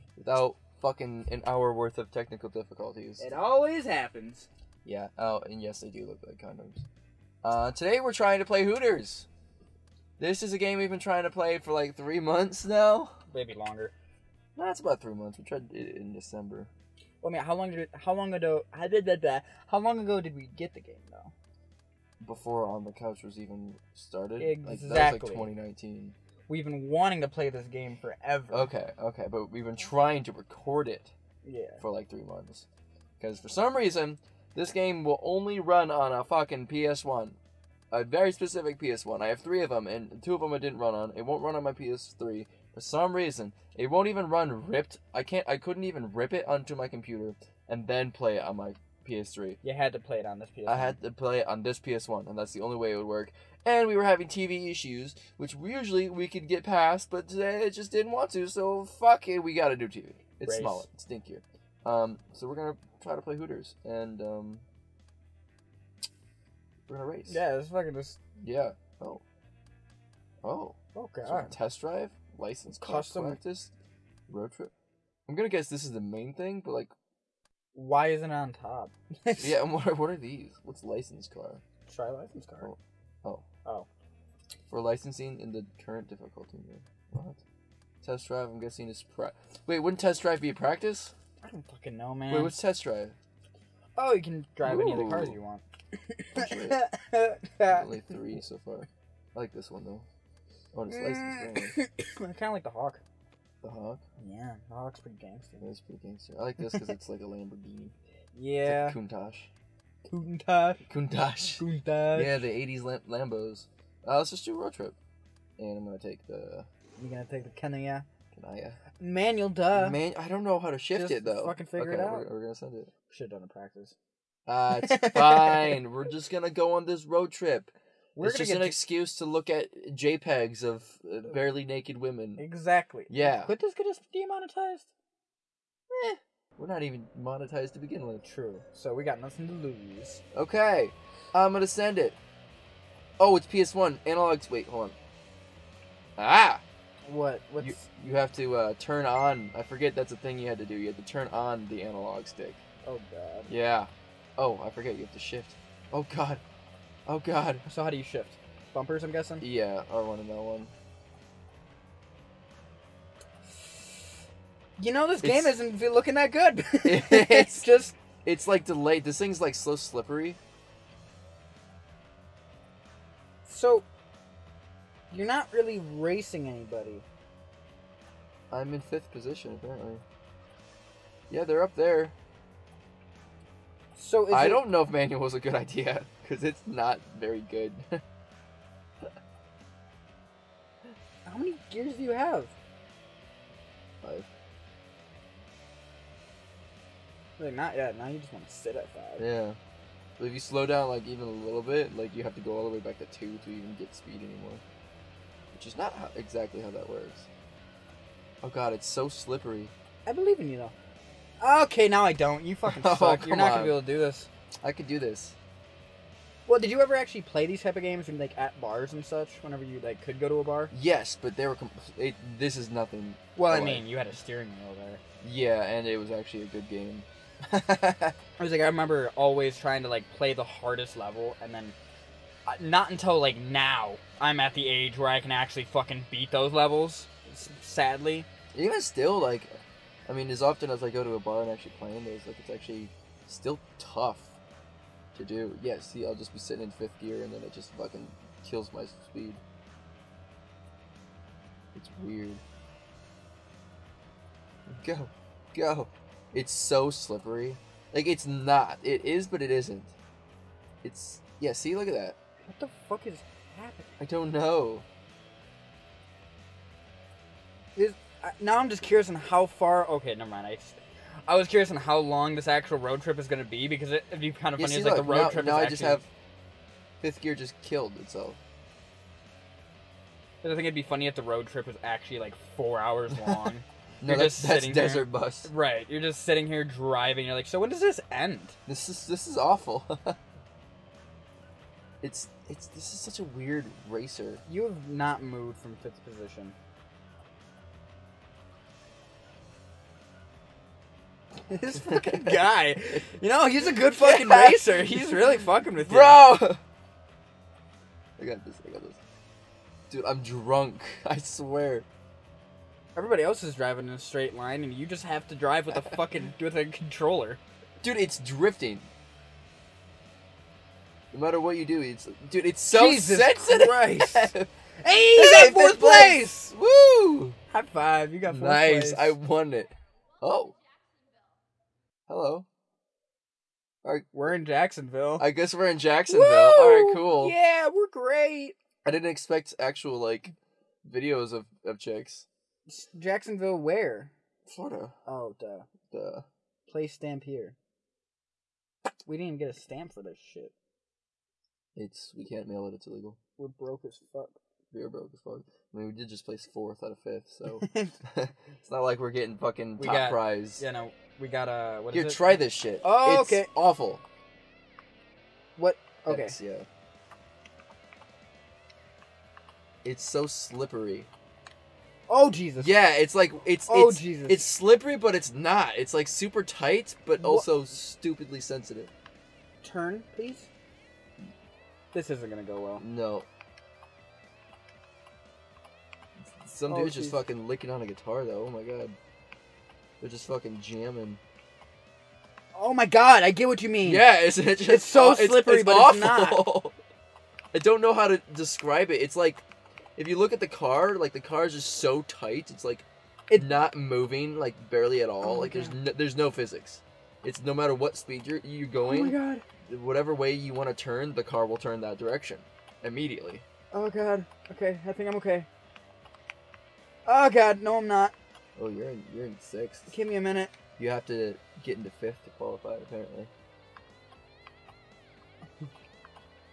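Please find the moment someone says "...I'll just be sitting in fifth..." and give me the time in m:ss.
4:06.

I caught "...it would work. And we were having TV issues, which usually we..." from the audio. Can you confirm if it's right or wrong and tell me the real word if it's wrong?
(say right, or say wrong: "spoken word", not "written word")
right.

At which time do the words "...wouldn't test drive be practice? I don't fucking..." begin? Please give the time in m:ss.
1:29.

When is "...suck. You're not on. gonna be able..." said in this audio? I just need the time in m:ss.
3:32.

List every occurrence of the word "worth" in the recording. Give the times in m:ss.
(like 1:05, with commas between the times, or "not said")
0:01.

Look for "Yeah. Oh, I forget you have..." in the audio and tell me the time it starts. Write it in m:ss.
2:33.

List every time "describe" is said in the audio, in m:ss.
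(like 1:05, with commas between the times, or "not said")
6:38.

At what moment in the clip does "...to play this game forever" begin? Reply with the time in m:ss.
0:27.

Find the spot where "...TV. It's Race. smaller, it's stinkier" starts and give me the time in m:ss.
0:59.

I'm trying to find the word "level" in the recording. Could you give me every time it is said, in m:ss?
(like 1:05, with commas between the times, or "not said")
3:50, 3:56.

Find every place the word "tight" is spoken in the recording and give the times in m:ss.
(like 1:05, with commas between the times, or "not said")
6:16, 6:42.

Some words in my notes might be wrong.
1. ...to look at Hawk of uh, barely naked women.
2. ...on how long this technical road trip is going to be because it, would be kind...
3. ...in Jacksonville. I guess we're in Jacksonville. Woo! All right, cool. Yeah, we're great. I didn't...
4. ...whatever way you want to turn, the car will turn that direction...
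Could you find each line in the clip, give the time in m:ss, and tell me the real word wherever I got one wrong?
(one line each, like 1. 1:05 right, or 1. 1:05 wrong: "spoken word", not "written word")
1. 2:09 wrong: "JPEGs", not "Hawk"
2. 4:31 wrong: "actual", not "technical"
3. 5:34 right
4. 6:49 right.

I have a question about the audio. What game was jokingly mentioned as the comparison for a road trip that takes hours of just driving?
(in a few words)
Desert Bus.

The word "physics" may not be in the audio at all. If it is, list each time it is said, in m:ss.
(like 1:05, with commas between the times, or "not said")
6:46.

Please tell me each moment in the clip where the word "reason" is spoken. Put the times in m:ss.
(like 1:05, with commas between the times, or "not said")
0:33, 0:43.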